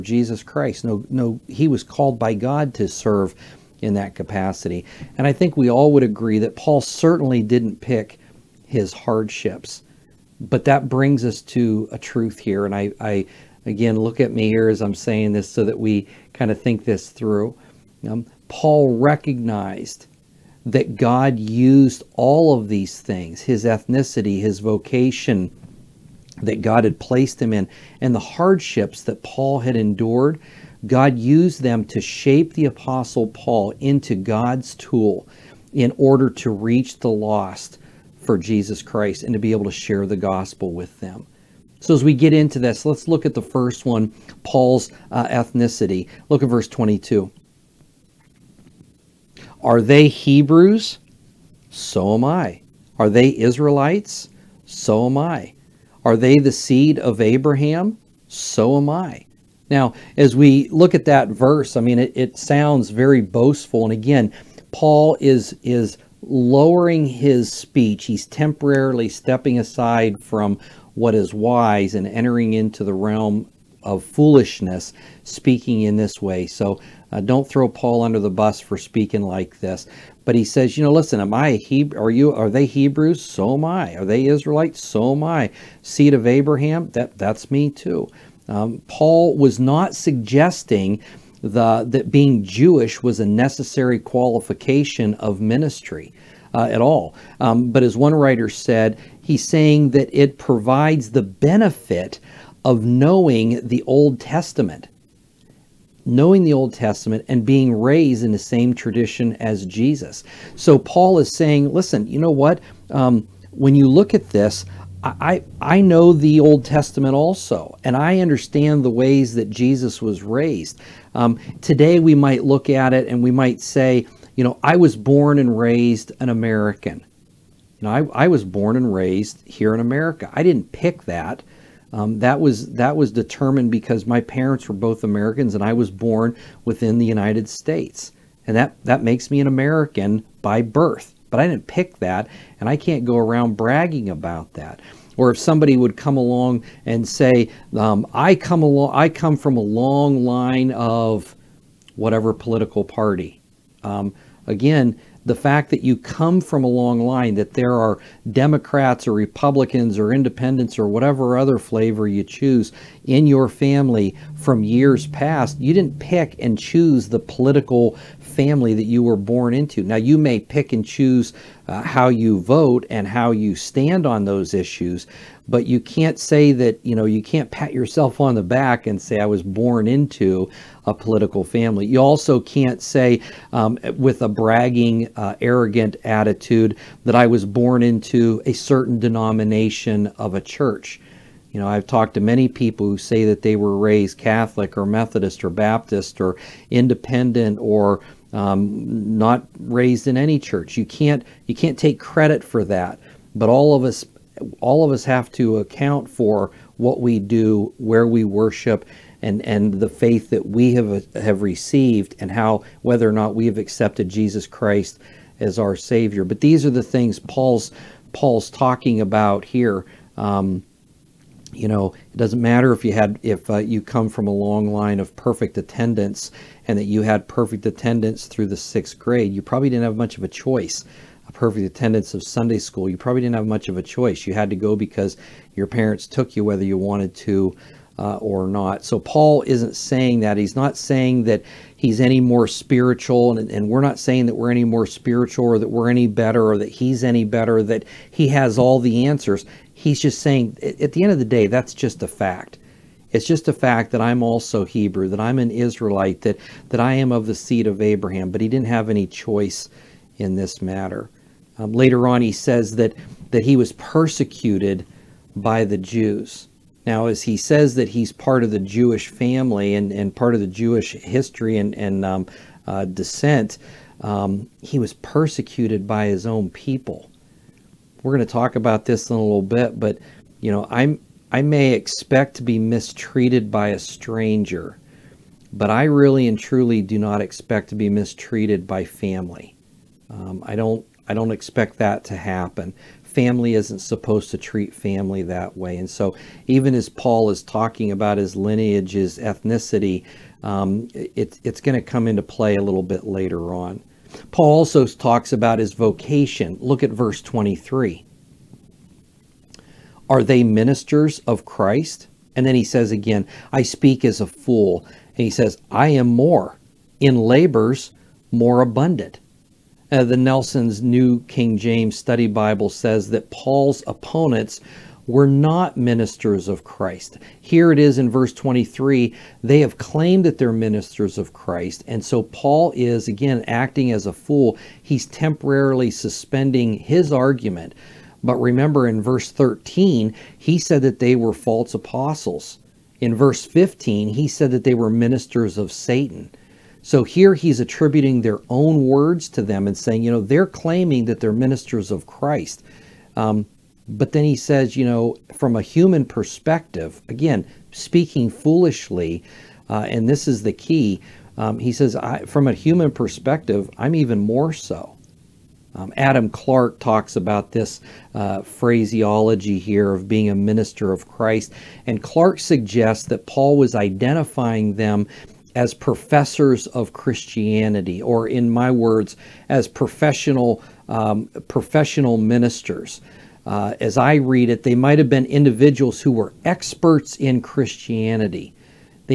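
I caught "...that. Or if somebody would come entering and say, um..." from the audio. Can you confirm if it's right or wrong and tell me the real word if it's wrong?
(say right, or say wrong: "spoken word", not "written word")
wrong: "along", not "entering".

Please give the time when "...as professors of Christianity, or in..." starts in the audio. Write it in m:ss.
6:15.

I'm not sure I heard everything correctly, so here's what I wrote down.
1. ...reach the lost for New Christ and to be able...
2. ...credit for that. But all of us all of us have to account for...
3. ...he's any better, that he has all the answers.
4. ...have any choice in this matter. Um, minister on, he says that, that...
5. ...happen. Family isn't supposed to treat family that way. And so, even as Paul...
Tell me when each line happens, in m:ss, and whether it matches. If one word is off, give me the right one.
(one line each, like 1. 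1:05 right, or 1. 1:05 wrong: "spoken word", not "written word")
1. 0:36 wrong: "Jesus", not "New"
2. 3:21 right
3. 4:06 right
4. 4:18 wrong: "later", not "minister"
5. 4:52 right.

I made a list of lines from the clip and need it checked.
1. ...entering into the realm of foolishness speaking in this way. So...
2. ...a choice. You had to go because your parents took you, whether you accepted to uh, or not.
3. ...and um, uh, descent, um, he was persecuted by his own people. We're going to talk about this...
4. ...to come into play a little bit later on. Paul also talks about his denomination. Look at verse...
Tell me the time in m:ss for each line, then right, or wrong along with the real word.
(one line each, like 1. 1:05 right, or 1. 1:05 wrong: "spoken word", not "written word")
1. 1:12 right
2. 3:53 wrong: "wanted", not "accepted"
3. 4:31 right
4. 5:01 wrong: "vocation", not "denomination".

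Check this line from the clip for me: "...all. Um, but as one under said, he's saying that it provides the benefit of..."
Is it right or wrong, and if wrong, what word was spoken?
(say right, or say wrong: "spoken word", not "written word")
wrong: "writer", not "under".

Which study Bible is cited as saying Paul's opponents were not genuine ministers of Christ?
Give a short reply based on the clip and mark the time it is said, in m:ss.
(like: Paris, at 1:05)
Nelson's New King James Study Bible, at 5:20.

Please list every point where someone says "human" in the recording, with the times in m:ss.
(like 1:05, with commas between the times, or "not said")
5:55, 6:02.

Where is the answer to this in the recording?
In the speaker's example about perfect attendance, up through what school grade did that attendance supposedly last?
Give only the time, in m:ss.
3:48.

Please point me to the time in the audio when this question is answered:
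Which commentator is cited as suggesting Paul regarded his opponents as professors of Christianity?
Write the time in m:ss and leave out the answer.
6:05.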